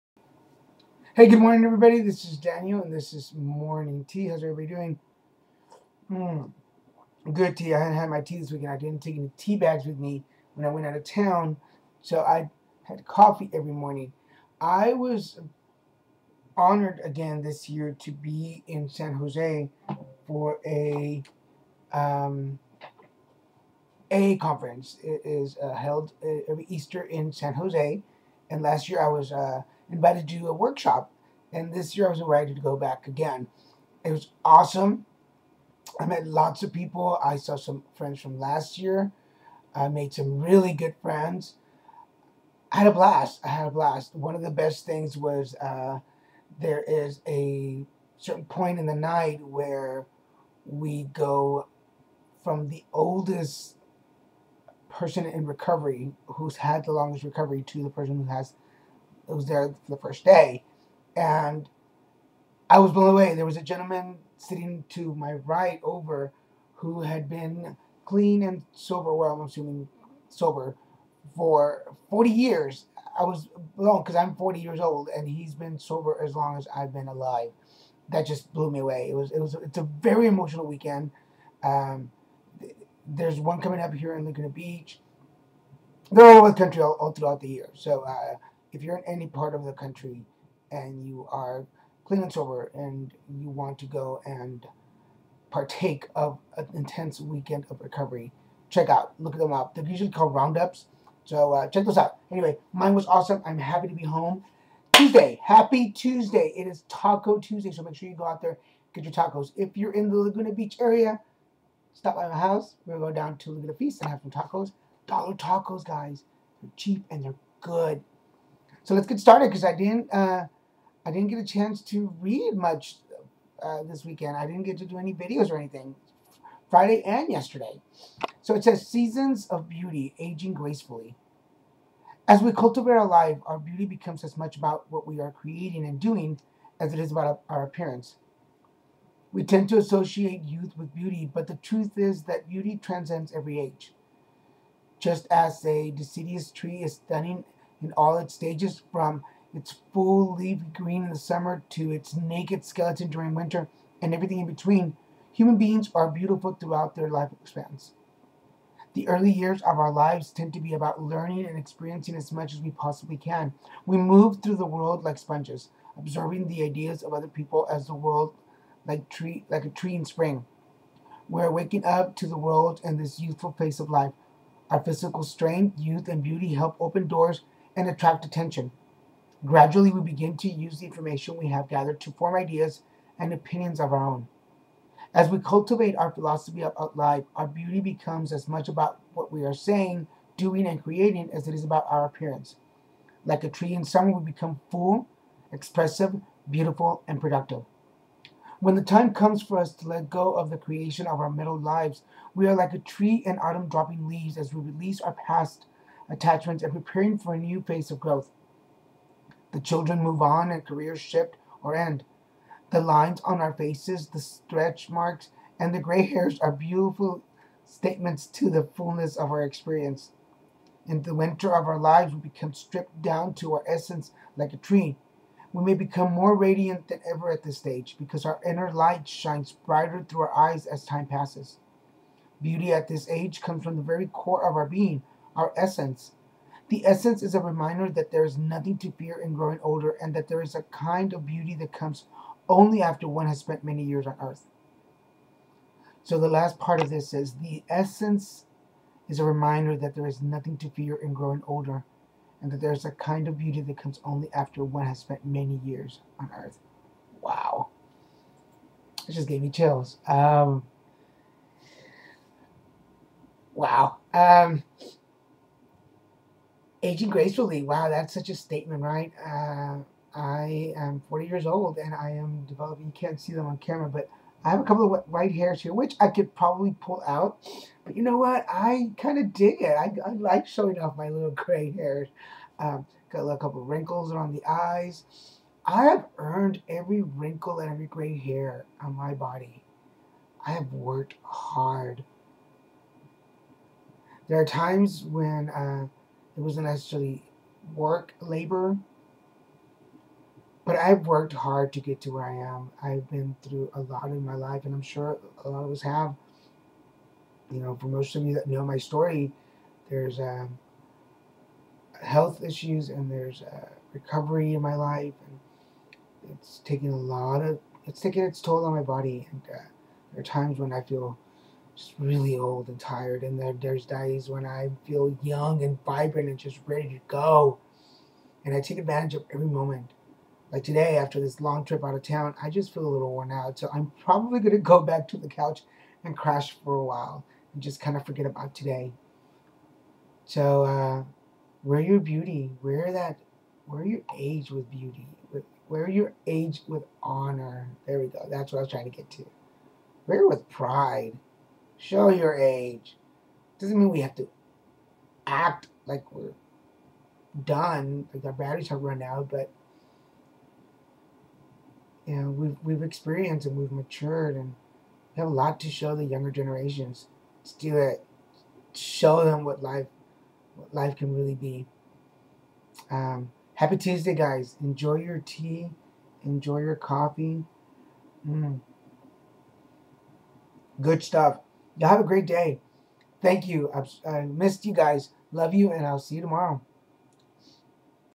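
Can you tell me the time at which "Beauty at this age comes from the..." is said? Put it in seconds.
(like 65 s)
232 s.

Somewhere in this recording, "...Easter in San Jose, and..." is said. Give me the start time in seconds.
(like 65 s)
26 s.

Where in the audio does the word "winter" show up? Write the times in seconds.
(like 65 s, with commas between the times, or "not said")
153 s, 221 s.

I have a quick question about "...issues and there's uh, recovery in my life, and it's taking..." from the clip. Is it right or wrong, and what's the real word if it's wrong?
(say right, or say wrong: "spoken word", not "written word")
right.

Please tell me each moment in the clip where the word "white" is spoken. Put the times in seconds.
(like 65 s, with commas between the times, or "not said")
275 s.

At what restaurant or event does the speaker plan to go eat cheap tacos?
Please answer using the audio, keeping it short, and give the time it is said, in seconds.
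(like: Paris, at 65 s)
Laguna Feast, at 113 s.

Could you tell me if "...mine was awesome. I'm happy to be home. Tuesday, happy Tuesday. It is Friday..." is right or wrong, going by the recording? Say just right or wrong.
wrong.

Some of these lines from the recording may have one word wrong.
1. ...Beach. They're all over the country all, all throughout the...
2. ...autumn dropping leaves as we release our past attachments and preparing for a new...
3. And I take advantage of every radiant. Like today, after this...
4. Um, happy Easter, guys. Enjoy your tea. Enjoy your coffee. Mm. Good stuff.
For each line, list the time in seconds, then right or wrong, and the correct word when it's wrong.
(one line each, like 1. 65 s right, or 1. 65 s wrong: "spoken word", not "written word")
1. 84 s right
2. 203 s right
3. 328 s wrong: "moment", not "radiant"
4. 372 s wrong: "Tuesday", not "Easter".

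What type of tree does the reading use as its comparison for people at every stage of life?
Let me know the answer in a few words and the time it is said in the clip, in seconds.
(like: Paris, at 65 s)
Deciduous tree, at 145 s.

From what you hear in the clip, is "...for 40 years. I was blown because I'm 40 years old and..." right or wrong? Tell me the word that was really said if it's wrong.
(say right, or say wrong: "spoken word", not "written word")
right.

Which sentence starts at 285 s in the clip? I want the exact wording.
I have earned every wrinkle and every gray hair on my body.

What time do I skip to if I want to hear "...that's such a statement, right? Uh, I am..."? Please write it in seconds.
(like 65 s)
267 s.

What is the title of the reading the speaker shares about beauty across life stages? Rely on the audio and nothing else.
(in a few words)
Seasons of beauty.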